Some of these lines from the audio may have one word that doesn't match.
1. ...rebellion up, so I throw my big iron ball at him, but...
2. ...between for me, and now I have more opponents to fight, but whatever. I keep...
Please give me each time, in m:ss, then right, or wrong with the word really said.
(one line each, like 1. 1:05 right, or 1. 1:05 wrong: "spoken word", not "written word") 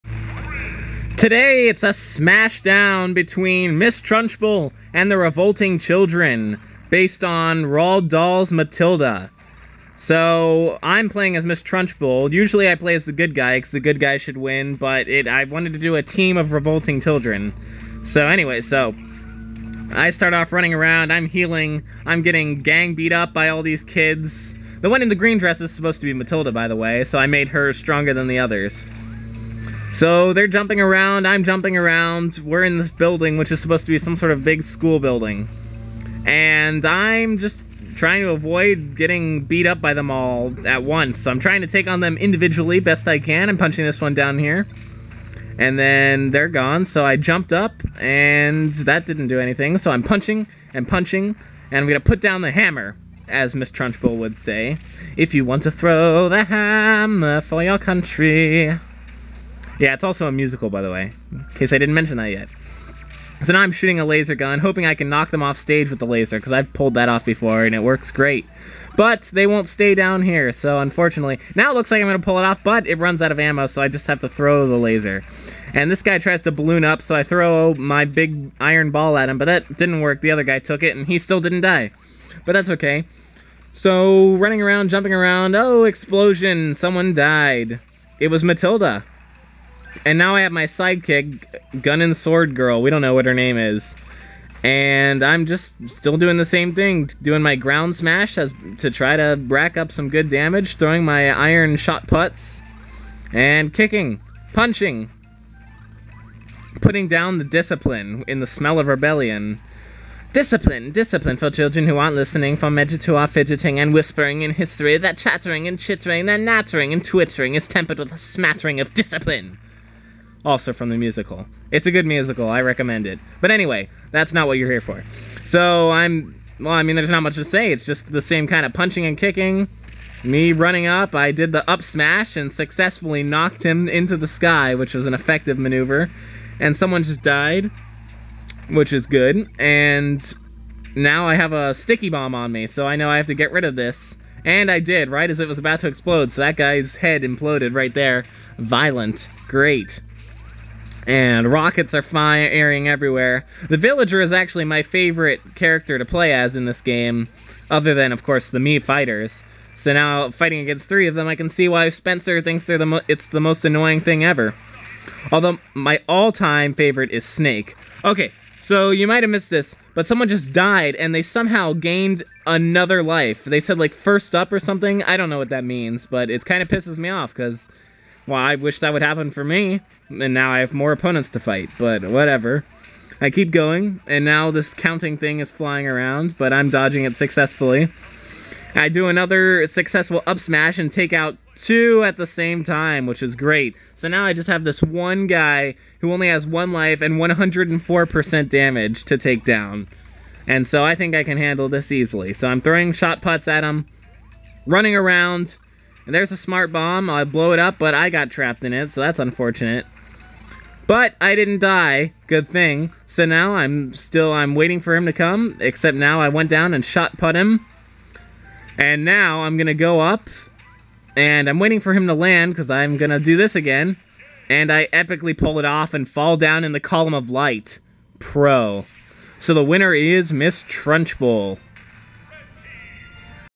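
1. 1:16 wrong: "balloon", not "rebellion"
2. 2:59 wrong: "happen", not "between".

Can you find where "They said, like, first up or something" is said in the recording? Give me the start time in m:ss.
2:53.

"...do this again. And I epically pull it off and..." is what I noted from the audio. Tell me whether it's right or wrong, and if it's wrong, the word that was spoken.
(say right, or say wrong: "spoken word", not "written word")
right.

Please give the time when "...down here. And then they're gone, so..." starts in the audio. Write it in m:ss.
0:44.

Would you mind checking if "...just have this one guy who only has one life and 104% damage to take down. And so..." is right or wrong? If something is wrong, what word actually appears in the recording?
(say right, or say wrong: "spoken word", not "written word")
right.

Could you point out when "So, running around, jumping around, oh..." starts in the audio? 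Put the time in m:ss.
1:23.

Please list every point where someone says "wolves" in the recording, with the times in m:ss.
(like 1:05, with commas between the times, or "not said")
not said.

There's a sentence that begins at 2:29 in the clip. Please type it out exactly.
Great and rockets are firing everywhere.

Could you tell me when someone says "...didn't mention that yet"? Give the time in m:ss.
1:01.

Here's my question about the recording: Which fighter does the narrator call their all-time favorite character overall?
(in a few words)
Snake.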